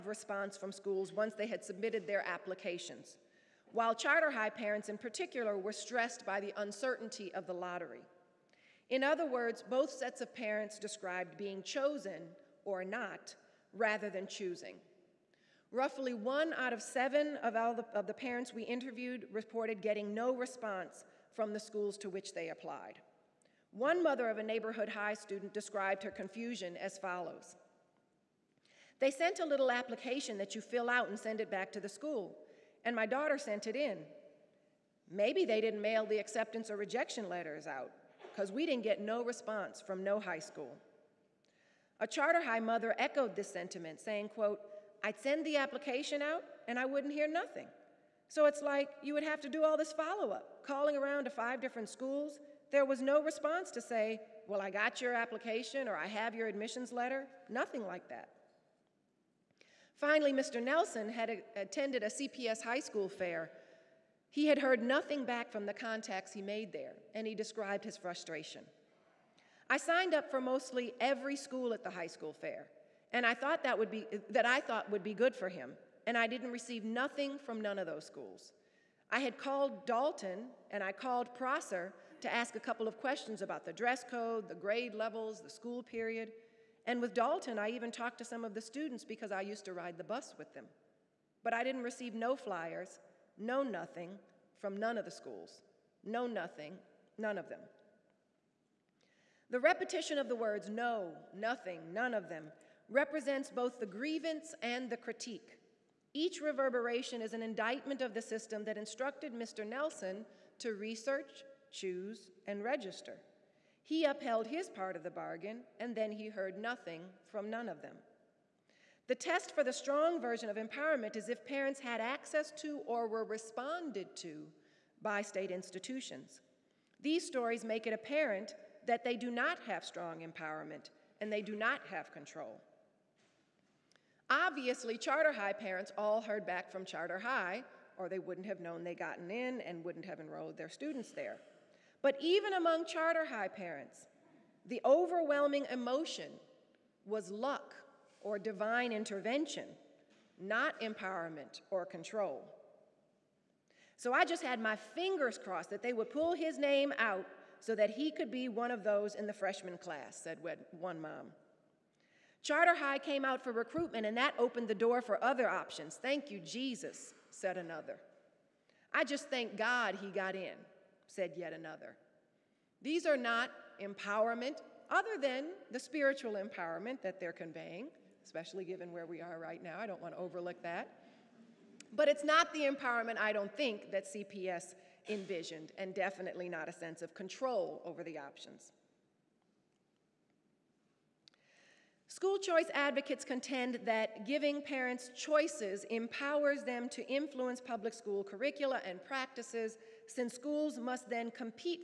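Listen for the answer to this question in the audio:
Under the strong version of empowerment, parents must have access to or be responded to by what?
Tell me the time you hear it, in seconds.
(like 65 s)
125 s.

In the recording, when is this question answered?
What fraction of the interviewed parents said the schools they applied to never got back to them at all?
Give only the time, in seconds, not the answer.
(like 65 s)
16 s.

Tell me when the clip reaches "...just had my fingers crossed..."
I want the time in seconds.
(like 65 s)
154 s.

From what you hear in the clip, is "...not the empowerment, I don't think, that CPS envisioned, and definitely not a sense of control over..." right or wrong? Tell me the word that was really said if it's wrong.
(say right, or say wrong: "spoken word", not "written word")
right.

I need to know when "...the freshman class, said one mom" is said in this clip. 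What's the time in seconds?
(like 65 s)
159 s.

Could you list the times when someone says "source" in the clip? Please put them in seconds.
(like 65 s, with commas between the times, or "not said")
not said.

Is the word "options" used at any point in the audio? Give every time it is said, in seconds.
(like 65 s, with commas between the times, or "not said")
165 s, 188 s.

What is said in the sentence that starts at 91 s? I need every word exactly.
But I didn't receive no flyers, know nothing from none of the schools.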